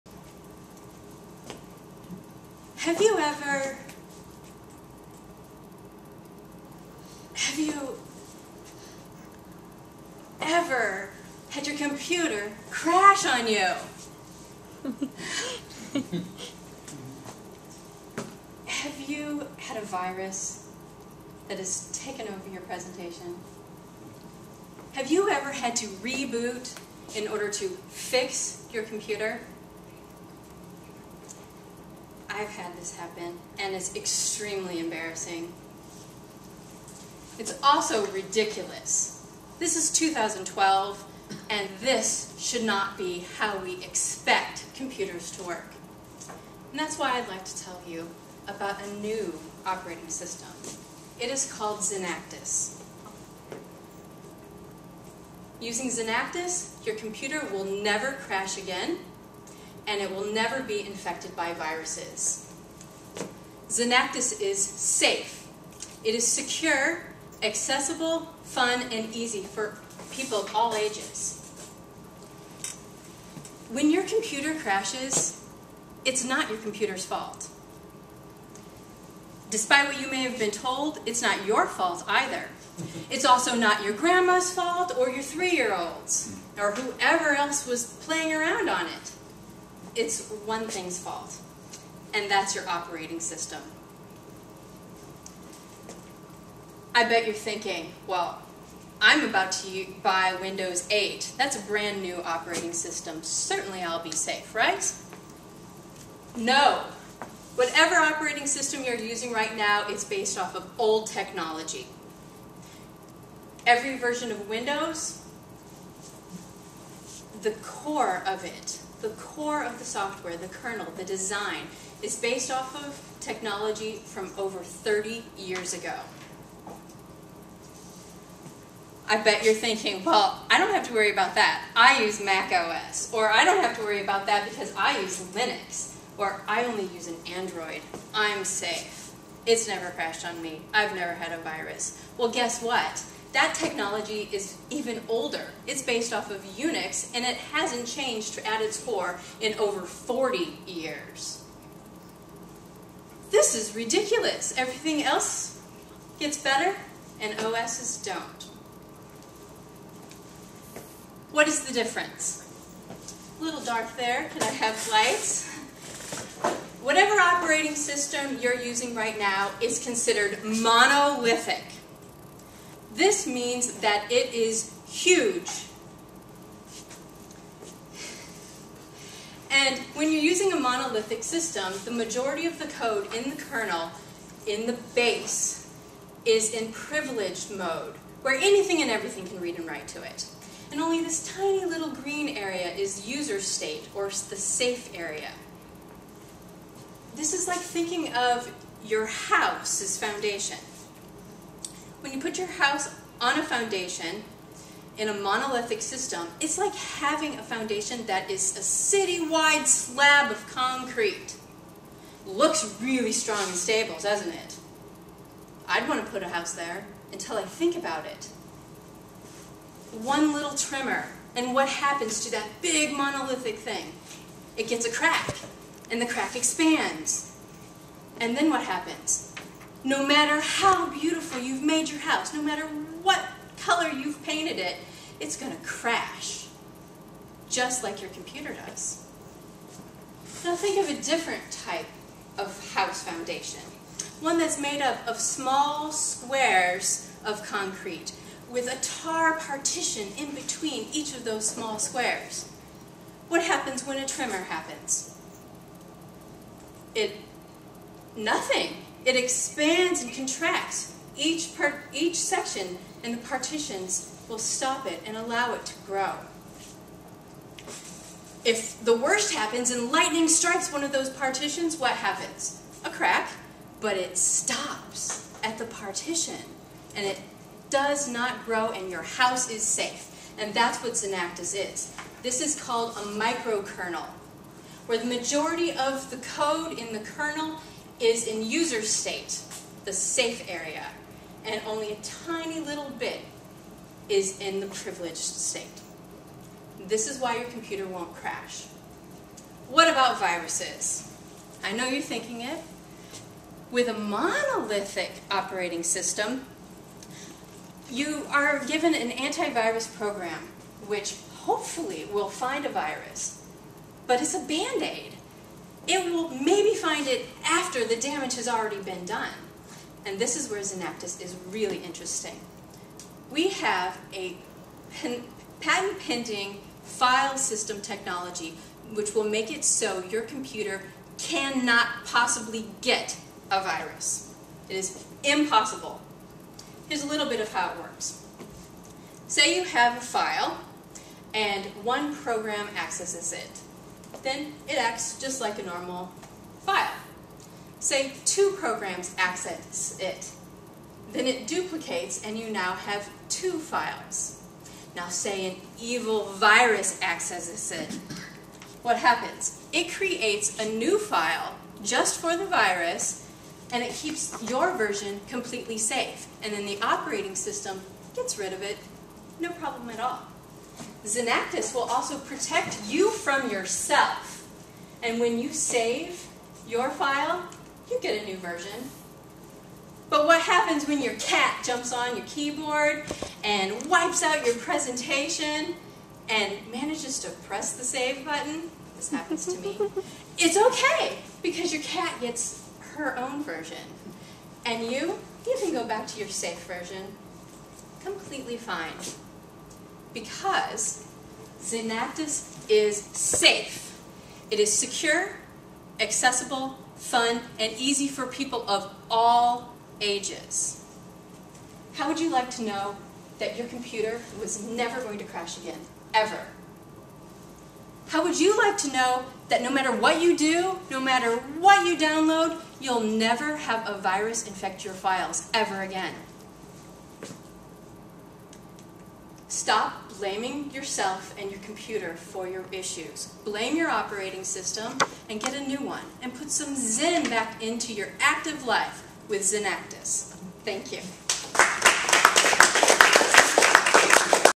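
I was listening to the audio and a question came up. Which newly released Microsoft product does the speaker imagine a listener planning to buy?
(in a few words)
Windows 8.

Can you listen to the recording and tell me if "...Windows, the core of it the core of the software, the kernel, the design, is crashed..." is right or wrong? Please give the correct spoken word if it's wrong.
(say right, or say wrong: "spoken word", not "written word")
wrong: "based", not "crashed".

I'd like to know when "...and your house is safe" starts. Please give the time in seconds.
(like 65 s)
278 s.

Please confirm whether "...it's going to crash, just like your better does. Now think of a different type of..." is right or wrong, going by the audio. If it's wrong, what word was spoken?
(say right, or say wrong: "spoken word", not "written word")
wrong: "computer", not "better".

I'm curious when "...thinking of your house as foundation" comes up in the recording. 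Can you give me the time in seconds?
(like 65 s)
197 s.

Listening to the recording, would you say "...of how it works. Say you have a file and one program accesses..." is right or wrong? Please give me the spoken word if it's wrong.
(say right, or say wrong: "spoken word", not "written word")
right.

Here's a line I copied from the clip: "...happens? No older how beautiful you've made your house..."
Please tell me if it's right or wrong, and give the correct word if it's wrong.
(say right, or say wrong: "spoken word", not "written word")
wrong: "matter", not "older".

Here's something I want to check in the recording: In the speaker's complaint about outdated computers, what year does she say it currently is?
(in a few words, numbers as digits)
2012.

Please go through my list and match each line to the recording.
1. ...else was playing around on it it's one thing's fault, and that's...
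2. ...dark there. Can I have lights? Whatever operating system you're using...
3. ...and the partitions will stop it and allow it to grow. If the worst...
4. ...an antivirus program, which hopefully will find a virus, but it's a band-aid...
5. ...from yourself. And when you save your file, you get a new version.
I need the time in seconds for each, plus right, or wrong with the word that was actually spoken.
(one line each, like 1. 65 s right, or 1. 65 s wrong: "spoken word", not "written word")
1. 87 s right
2. 163 s right
3. 263 s right
4. 308 s right
5. 373 s right.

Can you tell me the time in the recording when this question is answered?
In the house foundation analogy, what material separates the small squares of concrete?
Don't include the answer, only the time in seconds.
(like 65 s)
248 s.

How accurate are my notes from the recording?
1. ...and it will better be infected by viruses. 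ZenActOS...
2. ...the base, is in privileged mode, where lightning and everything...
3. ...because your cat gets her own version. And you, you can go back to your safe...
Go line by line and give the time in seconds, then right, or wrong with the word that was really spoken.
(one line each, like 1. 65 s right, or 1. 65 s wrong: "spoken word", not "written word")
1. 59 s wrong: "never", not "better"
2. 184 s wrong: "anything", not "lightning"
3. 391 s right.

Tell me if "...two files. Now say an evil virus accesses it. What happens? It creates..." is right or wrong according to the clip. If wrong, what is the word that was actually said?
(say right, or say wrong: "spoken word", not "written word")
right.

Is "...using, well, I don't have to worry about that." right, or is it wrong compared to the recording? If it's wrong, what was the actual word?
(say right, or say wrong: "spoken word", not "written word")
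wrong: "thinking", not "using".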